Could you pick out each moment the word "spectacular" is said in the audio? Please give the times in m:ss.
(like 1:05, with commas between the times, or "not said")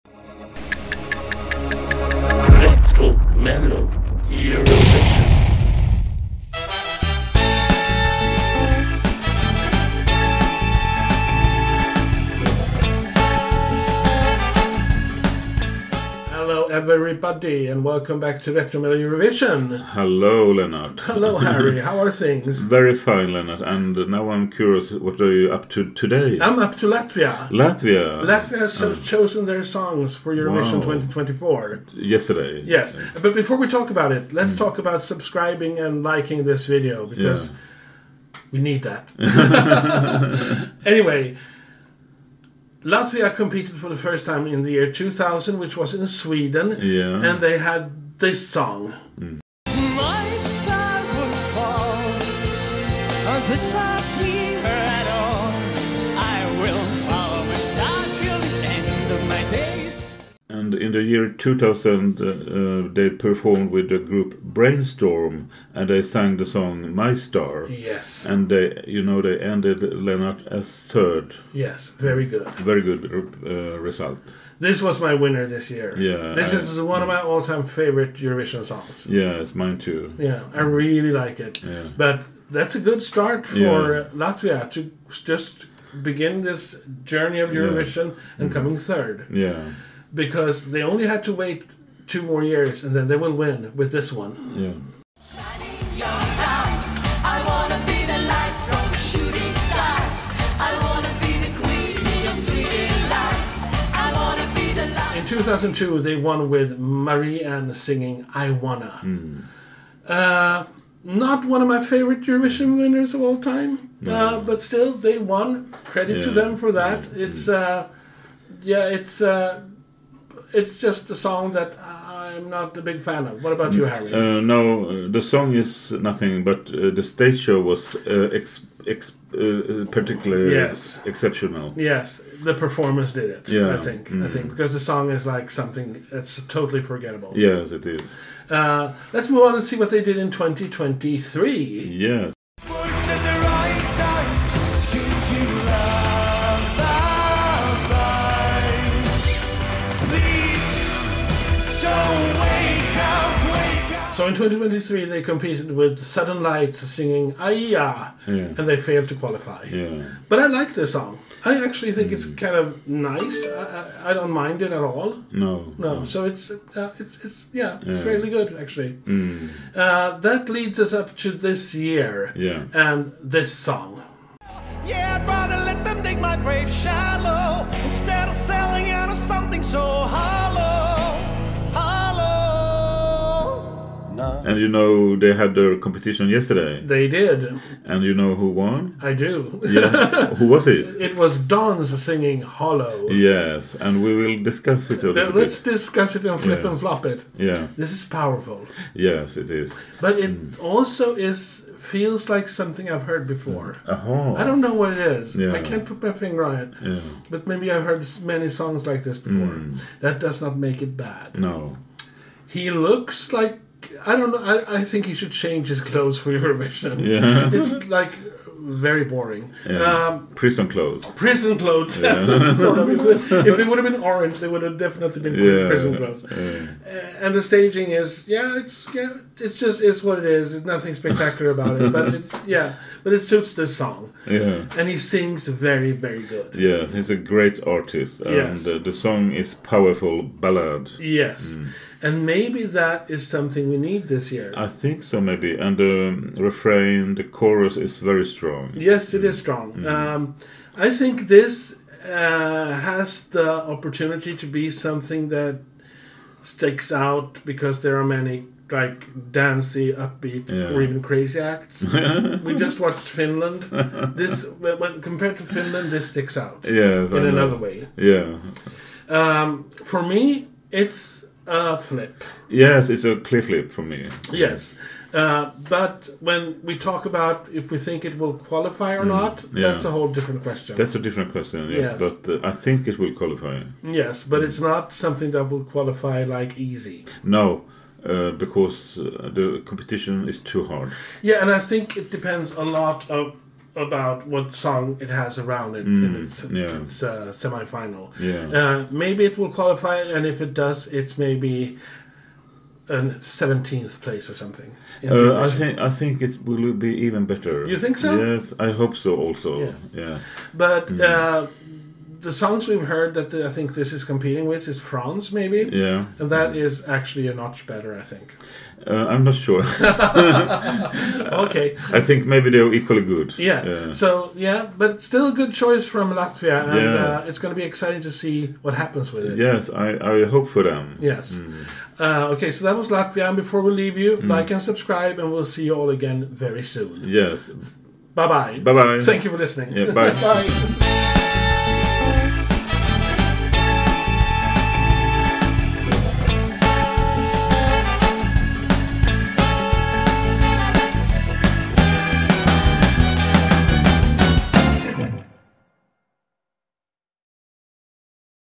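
3:50.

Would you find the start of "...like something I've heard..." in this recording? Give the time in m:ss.
3:22.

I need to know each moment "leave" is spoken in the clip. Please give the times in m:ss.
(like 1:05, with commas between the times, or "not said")
5:33.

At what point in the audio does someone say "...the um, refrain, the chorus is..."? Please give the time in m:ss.
4:05.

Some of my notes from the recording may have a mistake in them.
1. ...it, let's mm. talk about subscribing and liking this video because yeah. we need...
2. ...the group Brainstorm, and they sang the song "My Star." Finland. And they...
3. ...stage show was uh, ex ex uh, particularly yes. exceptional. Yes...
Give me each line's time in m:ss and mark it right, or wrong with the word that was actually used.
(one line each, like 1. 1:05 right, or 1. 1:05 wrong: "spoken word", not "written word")
1. 0:34 right
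2. 1:03 wrong: "Yes", not "Finland"
3. 2:07 right.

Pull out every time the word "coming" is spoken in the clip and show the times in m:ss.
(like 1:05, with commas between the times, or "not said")
1:28.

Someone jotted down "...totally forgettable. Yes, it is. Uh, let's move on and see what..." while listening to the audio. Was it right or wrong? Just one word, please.
right.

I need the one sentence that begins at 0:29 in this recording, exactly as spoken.
chosen their songs for Eurovision wow.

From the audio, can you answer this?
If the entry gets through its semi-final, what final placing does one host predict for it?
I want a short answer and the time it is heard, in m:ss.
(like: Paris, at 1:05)
17th place, at 5:03.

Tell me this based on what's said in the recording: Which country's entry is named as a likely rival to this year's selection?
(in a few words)
France.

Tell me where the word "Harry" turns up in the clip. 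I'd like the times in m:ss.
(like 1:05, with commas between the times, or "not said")
0:21, 2:03.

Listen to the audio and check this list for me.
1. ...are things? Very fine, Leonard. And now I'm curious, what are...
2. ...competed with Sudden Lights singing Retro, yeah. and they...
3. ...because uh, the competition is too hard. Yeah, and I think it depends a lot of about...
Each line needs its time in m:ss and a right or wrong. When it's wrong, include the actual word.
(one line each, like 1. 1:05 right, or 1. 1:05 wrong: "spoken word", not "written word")
1. 0:21 right
2. 2:35 wrong: "Aijā", not "Retro"
3. 4:48 right.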